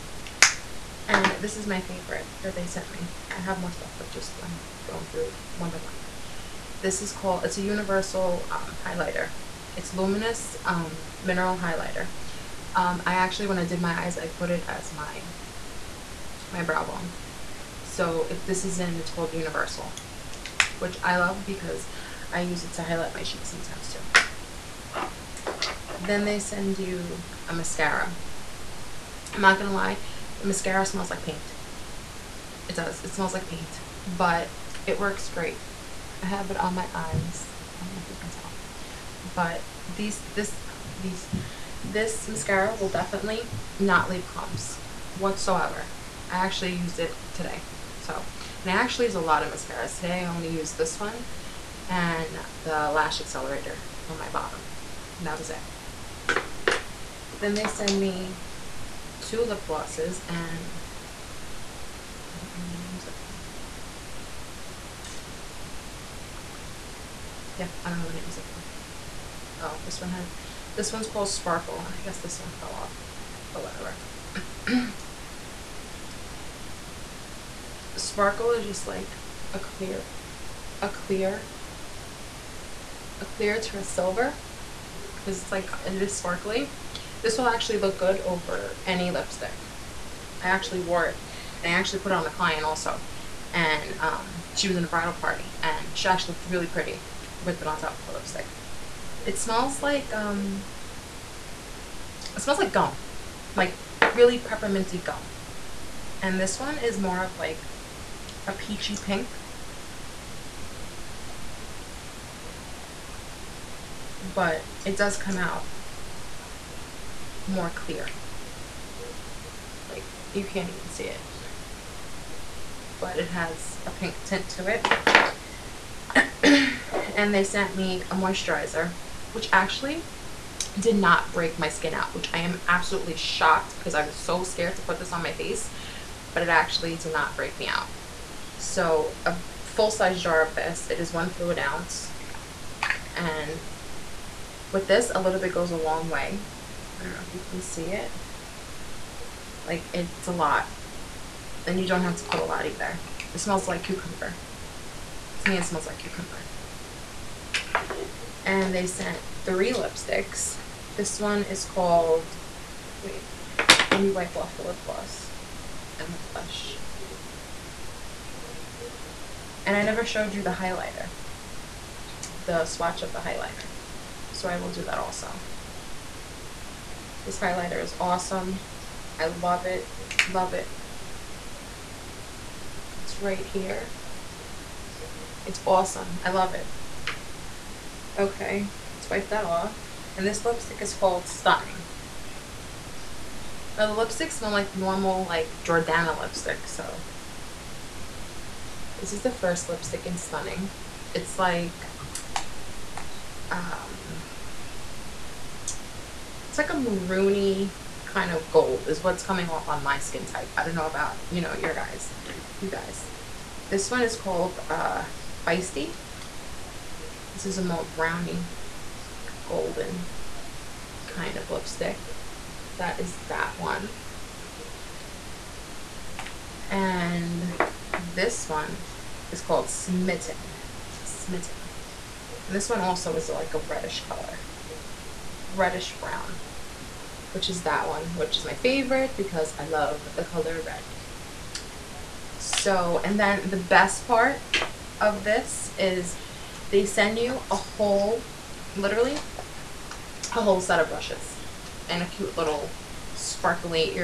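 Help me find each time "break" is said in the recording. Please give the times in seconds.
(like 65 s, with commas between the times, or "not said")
131 s, 137 s.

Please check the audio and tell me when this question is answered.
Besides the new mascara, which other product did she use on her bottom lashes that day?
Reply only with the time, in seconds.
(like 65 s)
52 s.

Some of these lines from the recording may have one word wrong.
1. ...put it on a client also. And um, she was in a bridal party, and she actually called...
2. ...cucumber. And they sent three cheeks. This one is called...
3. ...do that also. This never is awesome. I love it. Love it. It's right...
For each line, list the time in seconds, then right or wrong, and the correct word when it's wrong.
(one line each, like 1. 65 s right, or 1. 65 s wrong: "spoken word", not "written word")
1. 92 s wrong: "looked", not "called"
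2. 155 s wrong: "lipsticks", not "cheeks"
3. 174 s wrong: "highlighter", not "never".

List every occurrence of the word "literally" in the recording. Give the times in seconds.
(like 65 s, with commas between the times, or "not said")
248 s.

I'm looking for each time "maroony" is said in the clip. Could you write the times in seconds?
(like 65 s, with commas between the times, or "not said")
206 s.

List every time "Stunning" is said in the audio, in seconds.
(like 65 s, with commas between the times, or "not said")
191 s, 200 s.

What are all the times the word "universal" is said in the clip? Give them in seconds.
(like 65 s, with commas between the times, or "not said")
7 s, 19 s.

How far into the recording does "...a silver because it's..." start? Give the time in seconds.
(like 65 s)
83 s.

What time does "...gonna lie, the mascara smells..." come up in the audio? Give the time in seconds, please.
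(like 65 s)
29 s.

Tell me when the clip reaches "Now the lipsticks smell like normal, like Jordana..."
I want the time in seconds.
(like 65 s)
193 s.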